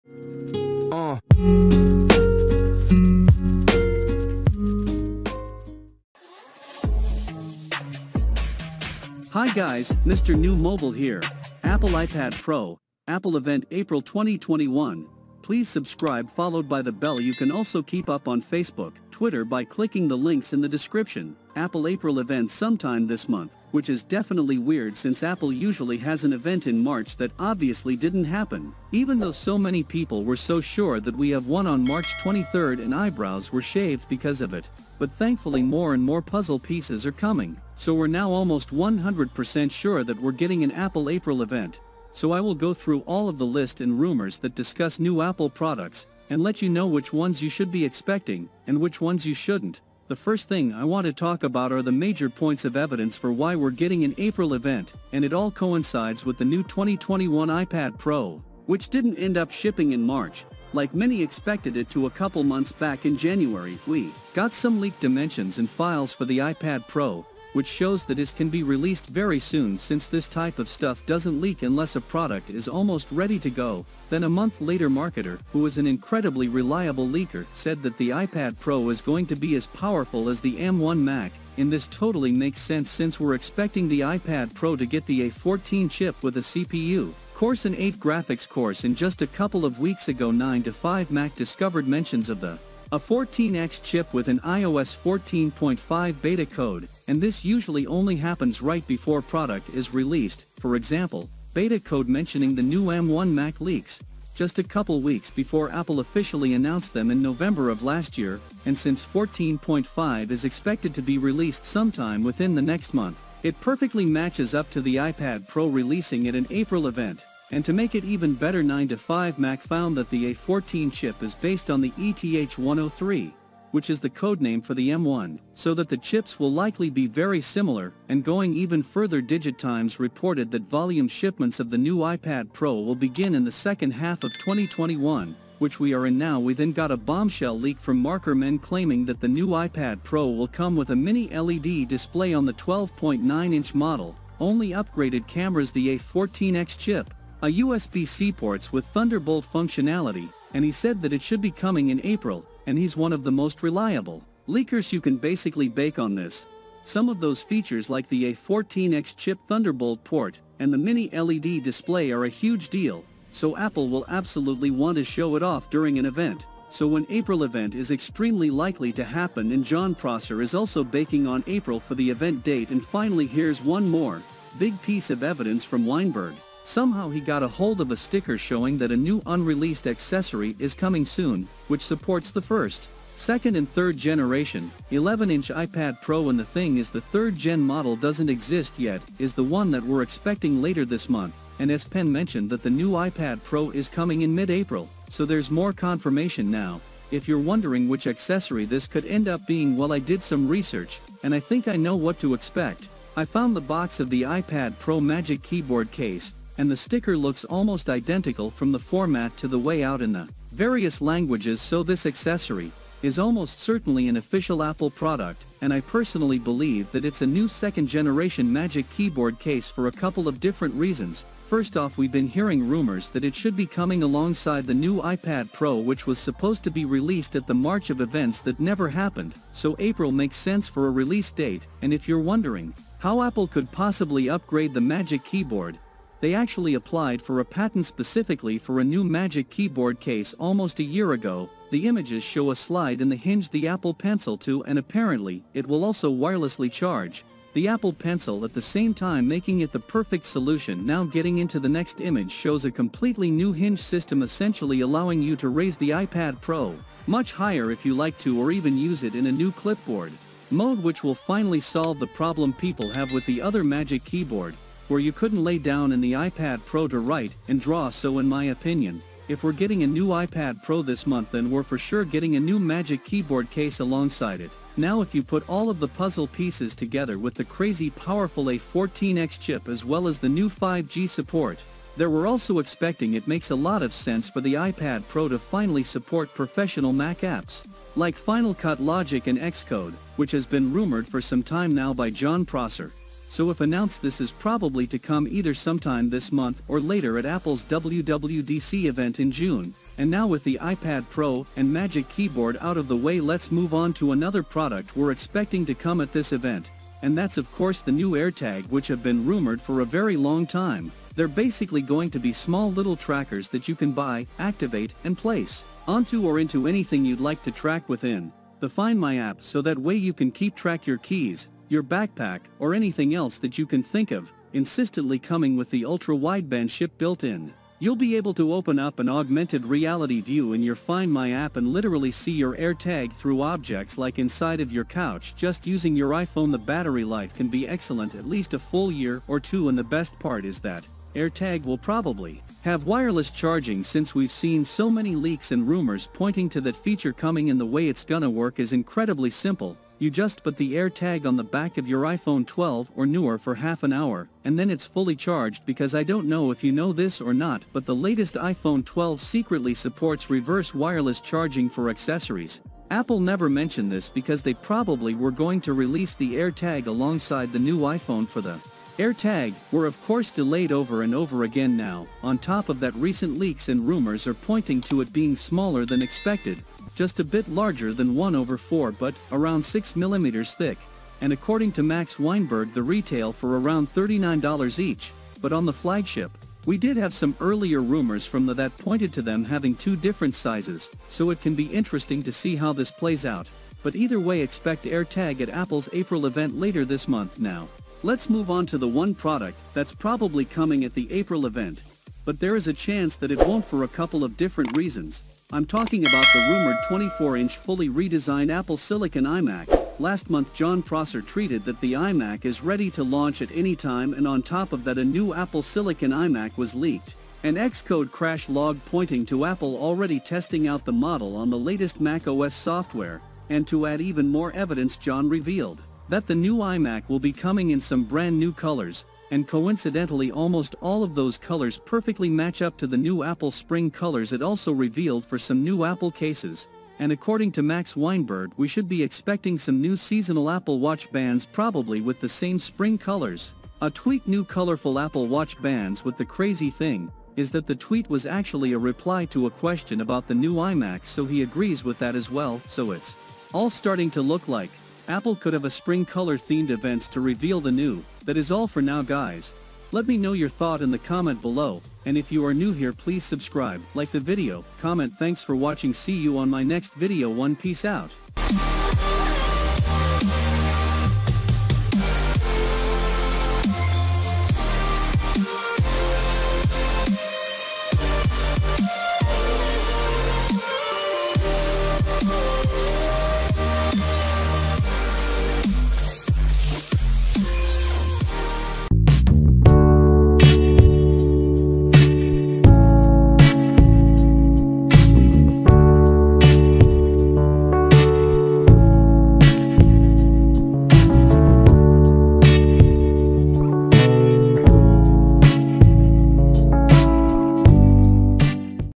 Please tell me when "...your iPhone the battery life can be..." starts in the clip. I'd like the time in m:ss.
5:35.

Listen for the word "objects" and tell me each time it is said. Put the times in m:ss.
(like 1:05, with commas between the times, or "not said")
5:33.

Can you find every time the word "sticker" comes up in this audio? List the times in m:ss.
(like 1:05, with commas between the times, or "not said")
2:57, 3:26.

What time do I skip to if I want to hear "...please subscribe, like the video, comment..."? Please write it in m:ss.
7:42.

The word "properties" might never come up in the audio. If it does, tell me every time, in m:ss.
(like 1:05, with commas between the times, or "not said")
not said.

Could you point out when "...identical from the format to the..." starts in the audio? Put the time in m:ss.
3:27.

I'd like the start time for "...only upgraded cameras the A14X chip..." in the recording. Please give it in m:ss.
2:24.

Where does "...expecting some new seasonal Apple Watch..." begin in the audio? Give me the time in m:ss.
7:19.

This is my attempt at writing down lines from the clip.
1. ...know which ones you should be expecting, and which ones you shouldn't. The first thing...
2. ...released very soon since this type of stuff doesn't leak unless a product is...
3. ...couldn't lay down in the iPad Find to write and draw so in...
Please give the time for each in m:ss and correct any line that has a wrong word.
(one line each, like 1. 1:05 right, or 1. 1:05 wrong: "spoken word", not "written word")
1. 0:46 right
2. 1:08 right
3. 4:25 wrong: "Pro", not "Find".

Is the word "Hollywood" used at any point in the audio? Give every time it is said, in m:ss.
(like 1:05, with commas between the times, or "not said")
not said.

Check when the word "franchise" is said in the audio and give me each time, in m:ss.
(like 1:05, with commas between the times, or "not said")
not said.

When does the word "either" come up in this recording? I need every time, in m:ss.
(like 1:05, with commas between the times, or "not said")
4:55, 6:33.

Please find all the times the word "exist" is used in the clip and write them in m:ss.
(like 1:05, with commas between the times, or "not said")
3:08.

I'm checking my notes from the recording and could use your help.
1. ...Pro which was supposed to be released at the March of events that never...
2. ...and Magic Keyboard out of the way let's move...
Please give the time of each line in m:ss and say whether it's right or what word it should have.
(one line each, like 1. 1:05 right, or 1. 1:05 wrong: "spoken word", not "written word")
1. 3:45 right
2. 5:01 right.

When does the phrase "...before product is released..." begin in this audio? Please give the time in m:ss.
1:38.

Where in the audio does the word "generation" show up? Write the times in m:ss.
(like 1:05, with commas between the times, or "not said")
3:03, 3:37.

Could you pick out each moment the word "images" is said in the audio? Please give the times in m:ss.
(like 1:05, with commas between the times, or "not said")
4:01, 4:11.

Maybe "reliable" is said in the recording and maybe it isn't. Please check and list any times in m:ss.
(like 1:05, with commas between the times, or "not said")
1:16, 2:33.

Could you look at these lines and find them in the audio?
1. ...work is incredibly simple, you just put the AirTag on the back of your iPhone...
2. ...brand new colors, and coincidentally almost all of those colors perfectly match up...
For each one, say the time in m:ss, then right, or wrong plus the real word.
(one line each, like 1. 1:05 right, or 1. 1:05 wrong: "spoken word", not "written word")
1. 5:48 right
2. 7:08 right.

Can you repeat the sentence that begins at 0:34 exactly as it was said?
But thankfully more and more puzzle pieces are coming, so we're now almost 100% sure that we're getting an Apple April event.